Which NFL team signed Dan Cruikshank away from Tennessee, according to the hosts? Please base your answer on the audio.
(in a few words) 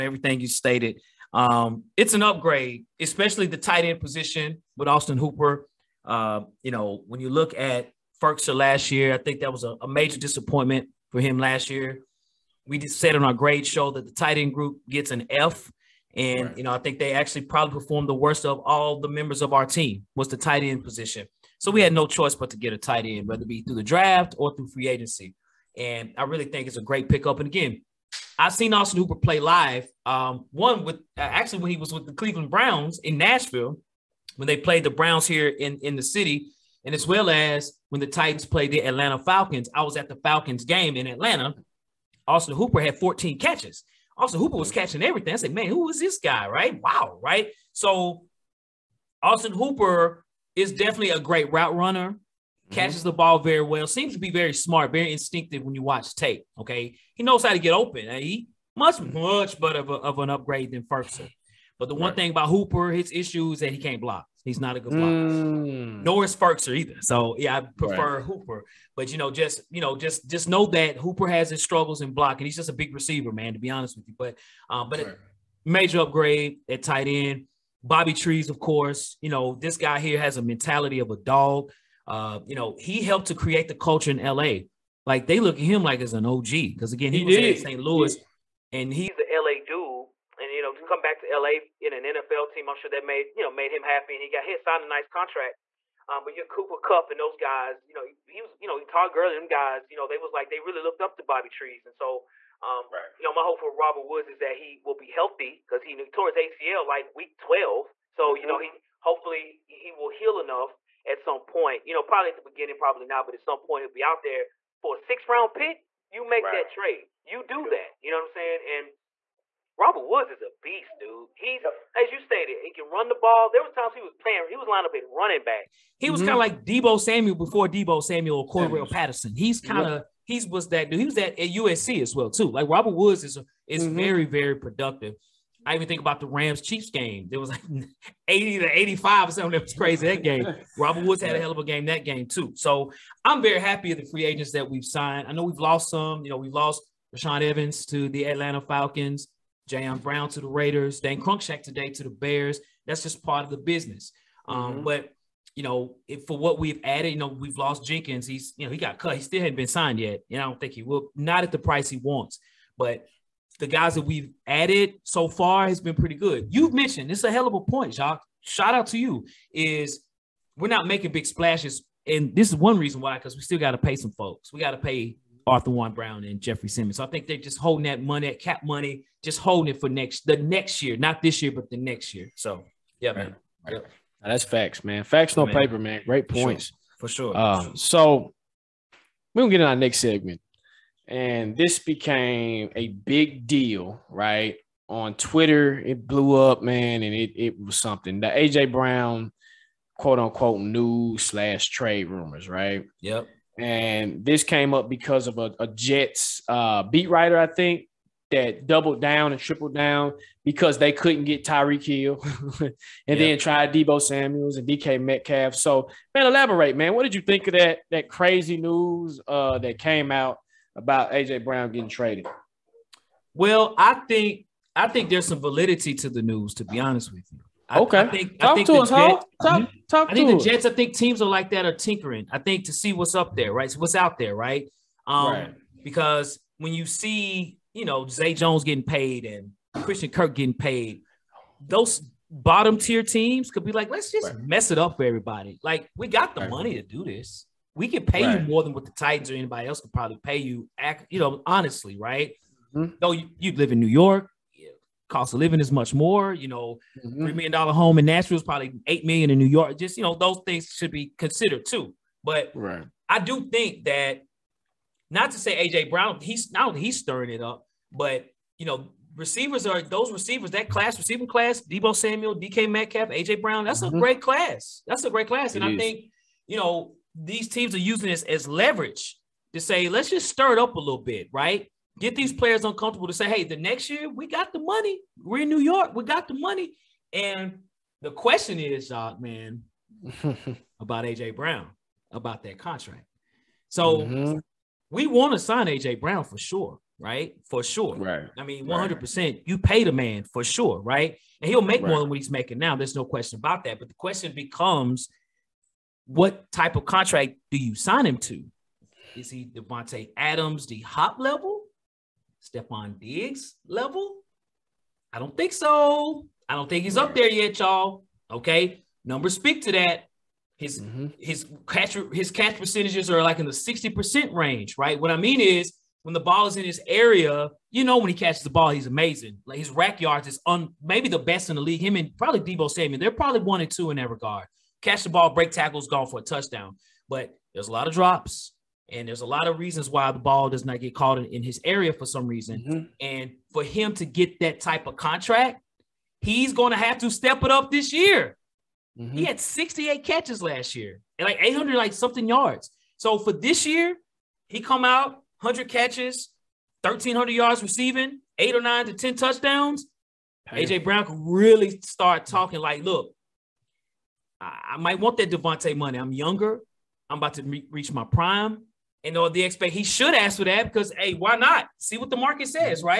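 Bears.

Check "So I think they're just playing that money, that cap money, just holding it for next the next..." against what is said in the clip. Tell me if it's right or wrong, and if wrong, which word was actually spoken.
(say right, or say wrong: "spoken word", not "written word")
wrong: "holding", not "playing".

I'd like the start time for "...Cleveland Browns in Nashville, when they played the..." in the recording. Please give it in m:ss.
0:32.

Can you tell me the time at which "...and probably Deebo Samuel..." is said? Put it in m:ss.
5:31.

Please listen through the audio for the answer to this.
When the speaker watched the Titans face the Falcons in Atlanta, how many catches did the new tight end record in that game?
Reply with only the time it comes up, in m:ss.
0:42.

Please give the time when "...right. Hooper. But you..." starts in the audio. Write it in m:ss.
1:08.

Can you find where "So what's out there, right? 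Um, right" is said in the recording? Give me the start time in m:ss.
3:53.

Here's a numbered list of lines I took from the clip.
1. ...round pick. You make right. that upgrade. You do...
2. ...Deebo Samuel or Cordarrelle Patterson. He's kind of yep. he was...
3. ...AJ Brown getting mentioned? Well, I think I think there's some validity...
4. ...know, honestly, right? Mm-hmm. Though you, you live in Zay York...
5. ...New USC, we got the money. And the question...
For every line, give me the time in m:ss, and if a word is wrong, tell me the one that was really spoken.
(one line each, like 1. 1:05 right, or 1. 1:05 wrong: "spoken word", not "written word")
1. 1:55 wrong: "trade", not "upgrade"
2. 2:07 right
3. 3:41 wrong: "traded", not "mentioned"
4. 4:11 wrong: "New", not "Zay"
5. 4:45 wrong: "York", not "USC".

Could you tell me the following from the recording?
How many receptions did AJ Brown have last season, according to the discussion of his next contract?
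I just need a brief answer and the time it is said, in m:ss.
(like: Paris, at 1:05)
68, at 5:49.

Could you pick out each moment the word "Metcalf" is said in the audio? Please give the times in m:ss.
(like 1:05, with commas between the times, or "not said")
3:35, 4:32.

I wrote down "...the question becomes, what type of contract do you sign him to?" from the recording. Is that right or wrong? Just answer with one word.
right.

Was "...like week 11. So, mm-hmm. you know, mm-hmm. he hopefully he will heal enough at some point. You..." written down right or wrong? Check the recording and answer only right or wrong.
wrong.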